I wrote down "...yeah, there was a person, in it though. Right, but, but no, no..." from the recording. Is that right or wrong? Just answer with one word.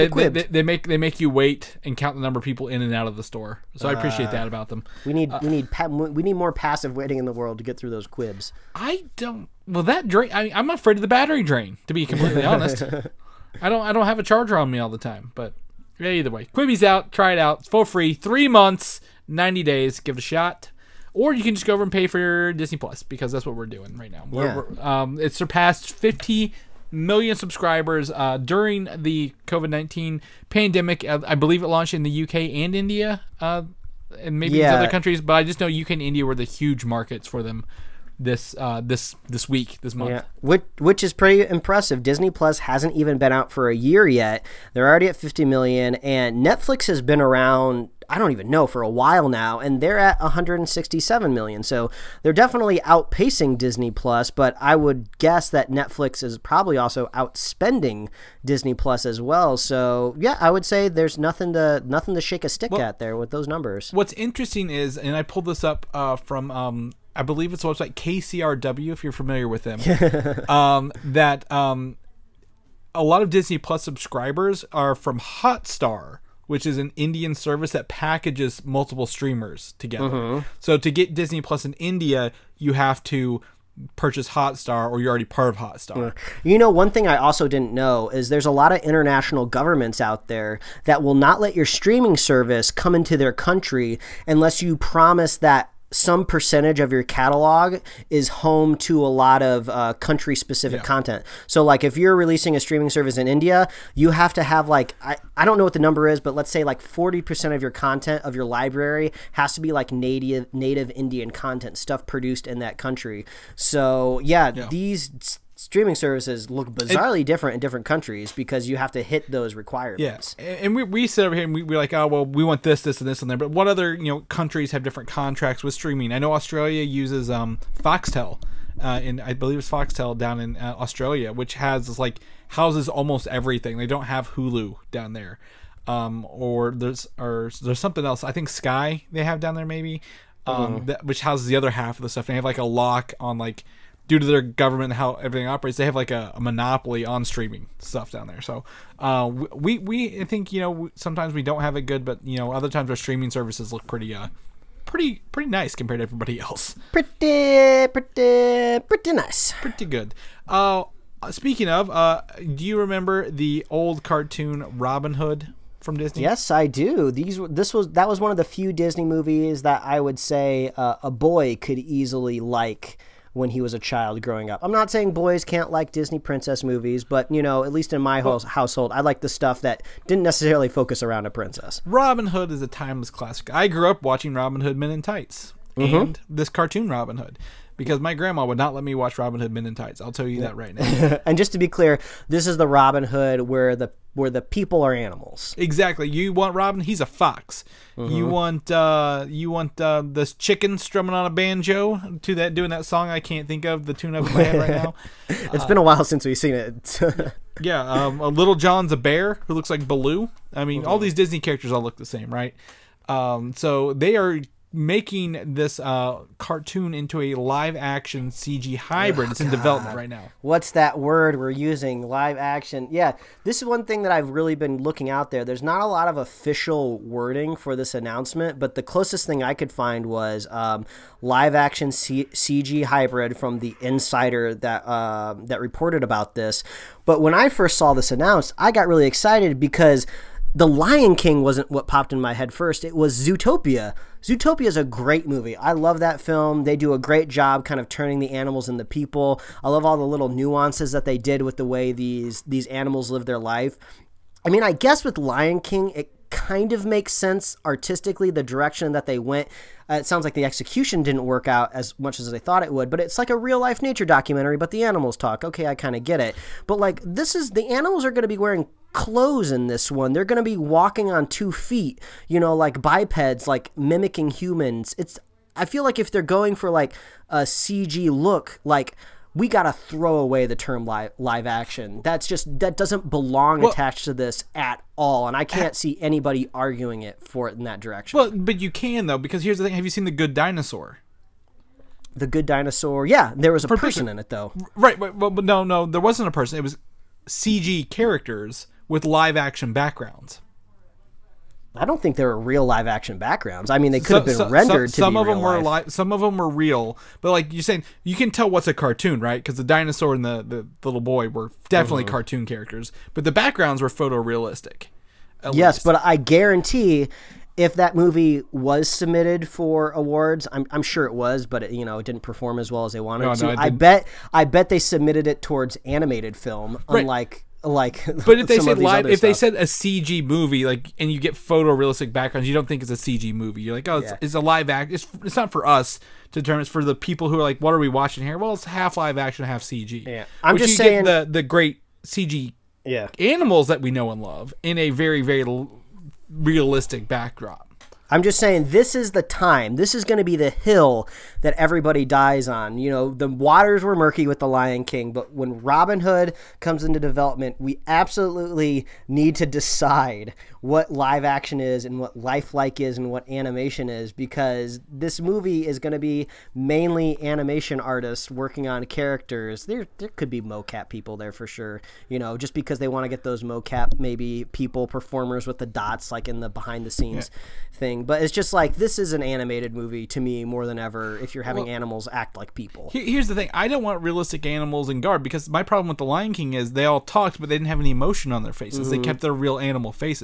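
right.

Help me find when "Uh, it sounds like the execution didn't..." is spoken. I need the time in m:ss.
4:19.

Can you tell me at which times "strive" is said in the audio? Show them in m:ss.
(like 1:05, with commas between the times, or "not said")
not said.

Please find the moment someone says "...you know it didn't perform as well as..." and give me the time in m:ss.
5:21.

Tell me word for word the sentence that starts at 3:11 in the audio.
and just to be clear, this is the Robin Hood where the where the people are animals.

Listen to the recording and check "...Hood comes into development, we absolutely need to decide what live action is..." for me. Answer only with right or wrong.
right.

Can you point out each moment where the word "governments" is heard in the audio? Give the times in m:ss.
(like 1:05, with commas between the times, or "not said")
1:29, 2:24.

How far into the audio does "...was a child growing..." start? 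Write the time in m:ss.
2:53.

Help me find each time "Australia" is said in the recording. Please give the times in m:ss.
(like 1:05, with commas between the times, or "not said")
2:06, 2:10.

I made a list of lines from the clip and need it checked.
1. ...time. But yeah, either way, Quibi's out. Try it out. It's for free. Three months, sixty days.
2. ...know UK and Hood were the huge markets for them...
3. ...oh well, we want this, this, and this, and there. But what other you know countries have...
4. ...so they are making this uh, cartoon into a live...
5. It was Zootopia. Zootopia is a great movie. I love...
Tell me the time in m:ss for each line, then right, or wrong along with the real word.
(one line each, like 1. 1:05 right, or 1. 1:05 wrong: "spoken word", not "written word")
1. 0:14 wrong: "ninety", not "sixty"
2. 0:35 wrong: "India", not "Hood"
3. 2:01 right
4. 3:33 right
5. 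4:02 right.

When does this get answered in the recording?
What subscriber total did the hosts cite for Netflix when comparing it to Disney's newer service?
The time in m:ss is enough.
0:50.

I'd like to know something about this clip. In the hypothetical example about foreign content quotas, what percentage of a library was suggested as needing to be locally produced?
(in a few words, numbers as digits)
40%.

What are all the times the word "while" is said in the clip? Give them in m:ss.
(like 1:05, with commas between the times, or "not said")
0:48, 3:25.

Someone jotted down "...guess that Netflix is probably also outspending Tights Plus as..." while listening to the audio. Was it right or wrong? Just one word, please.
wrong.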